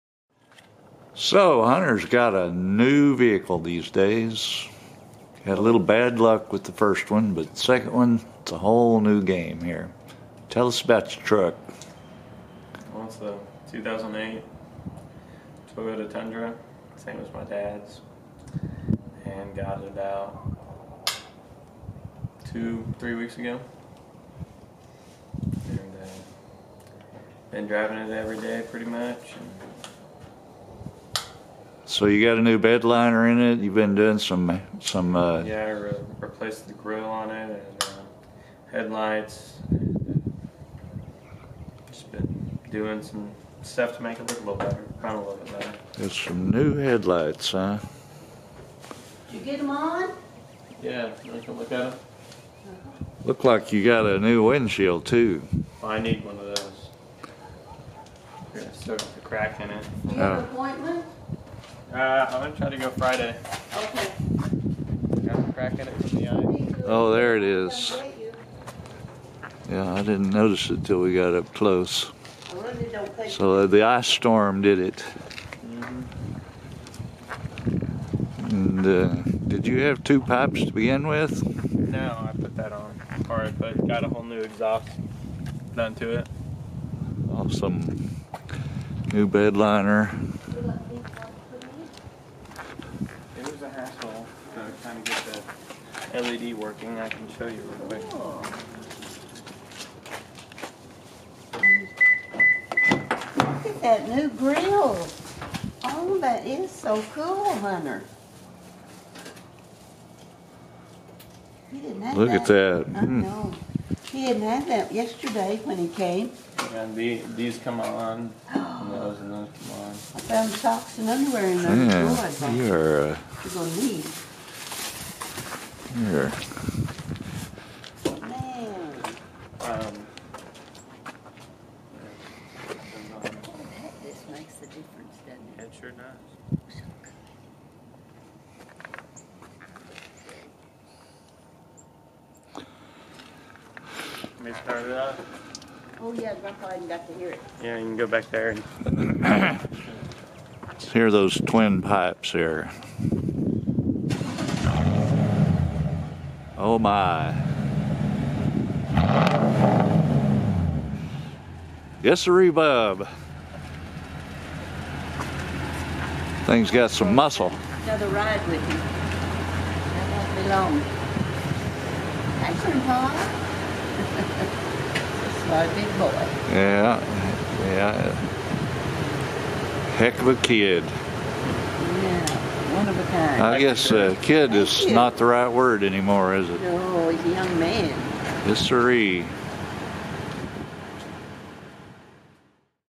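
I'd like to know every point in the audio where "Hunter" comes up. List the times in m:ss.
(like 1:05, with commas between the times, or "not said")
0:01, 1:47.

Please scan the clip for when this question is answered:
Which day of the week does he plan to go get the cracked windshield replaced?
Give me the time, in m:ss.
1:02.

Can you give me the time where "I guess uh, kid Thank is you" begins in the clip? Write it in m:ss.
3:03.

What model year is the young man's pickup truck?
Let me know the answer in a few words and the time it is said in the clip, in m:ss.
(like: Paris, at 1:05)
2008, at 0:13.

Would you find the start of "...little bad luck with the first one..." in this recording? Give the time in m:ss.
0:05.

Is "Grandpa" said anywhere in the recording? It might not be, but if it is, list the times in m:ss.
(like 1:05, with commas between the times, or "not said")
2:26, 2:52.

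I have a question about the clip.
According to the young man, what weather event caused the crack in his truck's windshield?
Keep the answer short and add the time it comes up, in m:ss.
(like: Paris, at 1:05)
ice storm, at 1:13.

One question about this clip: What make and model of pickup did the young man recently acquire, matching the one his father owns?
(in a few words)
Toyota Tundra.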